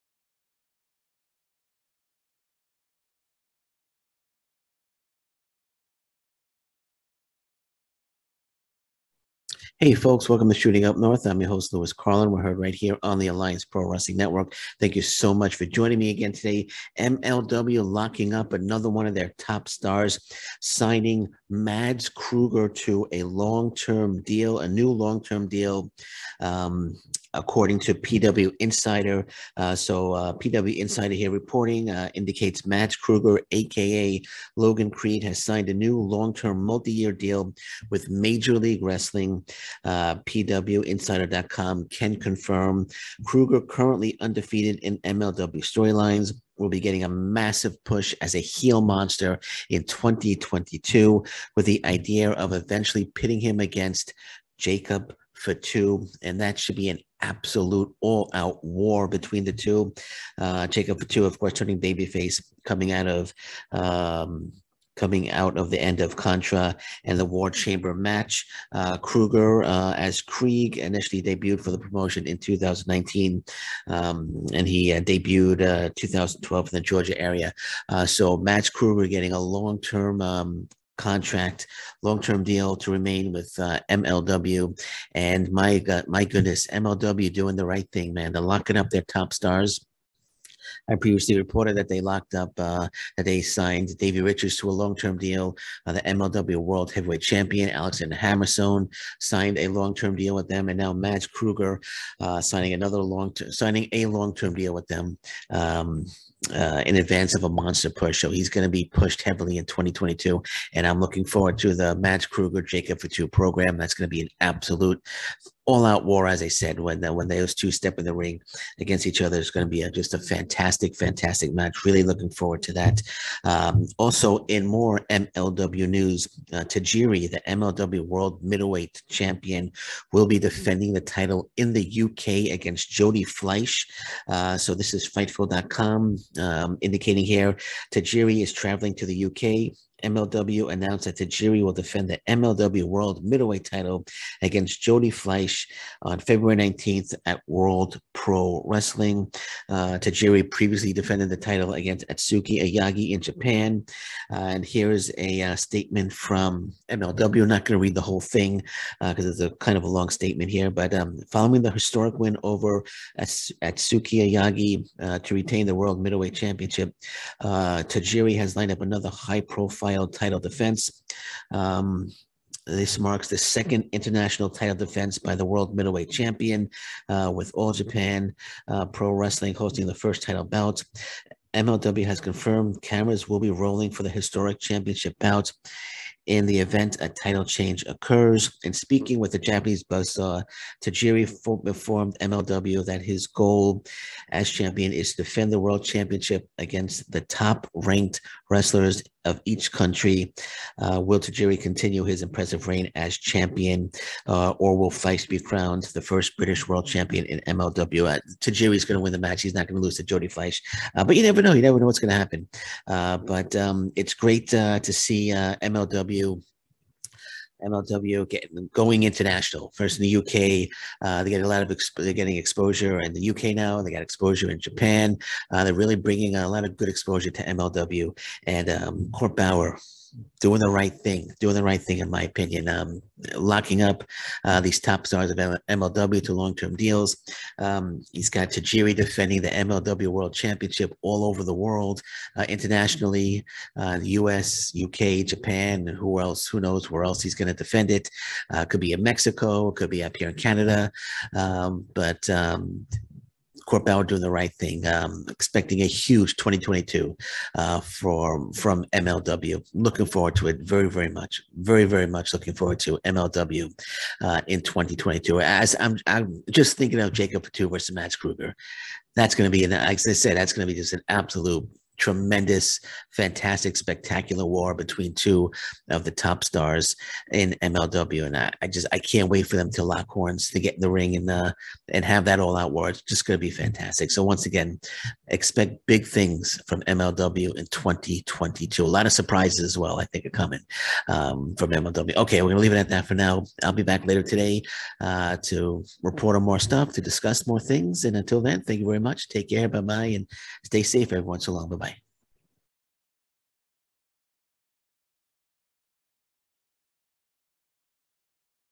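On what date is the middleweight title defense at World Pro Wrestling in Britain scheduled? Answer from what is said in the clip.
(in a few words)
February 19.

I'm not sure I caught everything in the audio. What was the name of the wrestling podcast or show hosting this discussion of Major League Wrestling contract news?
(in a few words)
Shooting Up North.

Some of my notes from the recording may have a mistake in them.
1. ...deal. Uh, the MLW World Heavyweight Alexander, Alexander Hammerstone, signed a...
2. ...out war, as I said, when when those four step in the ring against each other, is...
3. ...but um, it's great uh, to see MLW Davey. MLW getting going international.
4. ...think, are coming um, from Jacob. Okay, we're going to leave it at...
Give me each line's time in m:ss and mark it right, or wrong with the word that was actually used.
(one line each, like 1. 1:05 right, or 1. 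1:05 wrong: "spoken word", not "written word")
1. 1:35 wrong: "Champion", not "Alexander"
2. 1:55 wrong: "two", not "four"
3. 3:33 wrong: "MLW", not "Davey"
4. 4:50 wrong: "MLW", not "Jacob".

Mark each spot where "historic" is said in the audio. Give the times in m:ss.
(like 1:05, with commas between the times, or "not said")
2:41, 3:04.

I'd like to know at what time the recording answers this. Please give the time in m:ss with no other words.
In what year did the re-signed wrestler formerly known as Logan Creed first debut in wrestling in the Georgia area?
1:15.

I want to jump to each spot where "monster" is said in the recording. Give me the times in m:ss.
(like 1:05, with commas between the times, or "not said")
0:48, 1:47.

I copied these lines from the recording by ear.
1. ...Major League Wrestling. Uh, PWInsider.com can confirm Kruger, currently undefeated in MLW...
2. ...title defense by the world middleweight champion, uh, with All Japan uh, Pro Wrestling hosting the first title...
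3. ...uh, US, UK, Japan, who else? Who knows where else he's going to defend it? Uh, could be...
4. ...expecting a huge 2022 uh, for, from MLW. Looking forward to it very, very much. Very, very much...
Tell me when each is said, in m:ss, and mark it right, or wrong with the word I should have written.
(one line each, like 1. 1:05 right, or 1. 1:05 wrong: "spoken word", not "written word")
1. 0:38 right
2. 2:54 right
3. 4:03 right
4. 4:15 right.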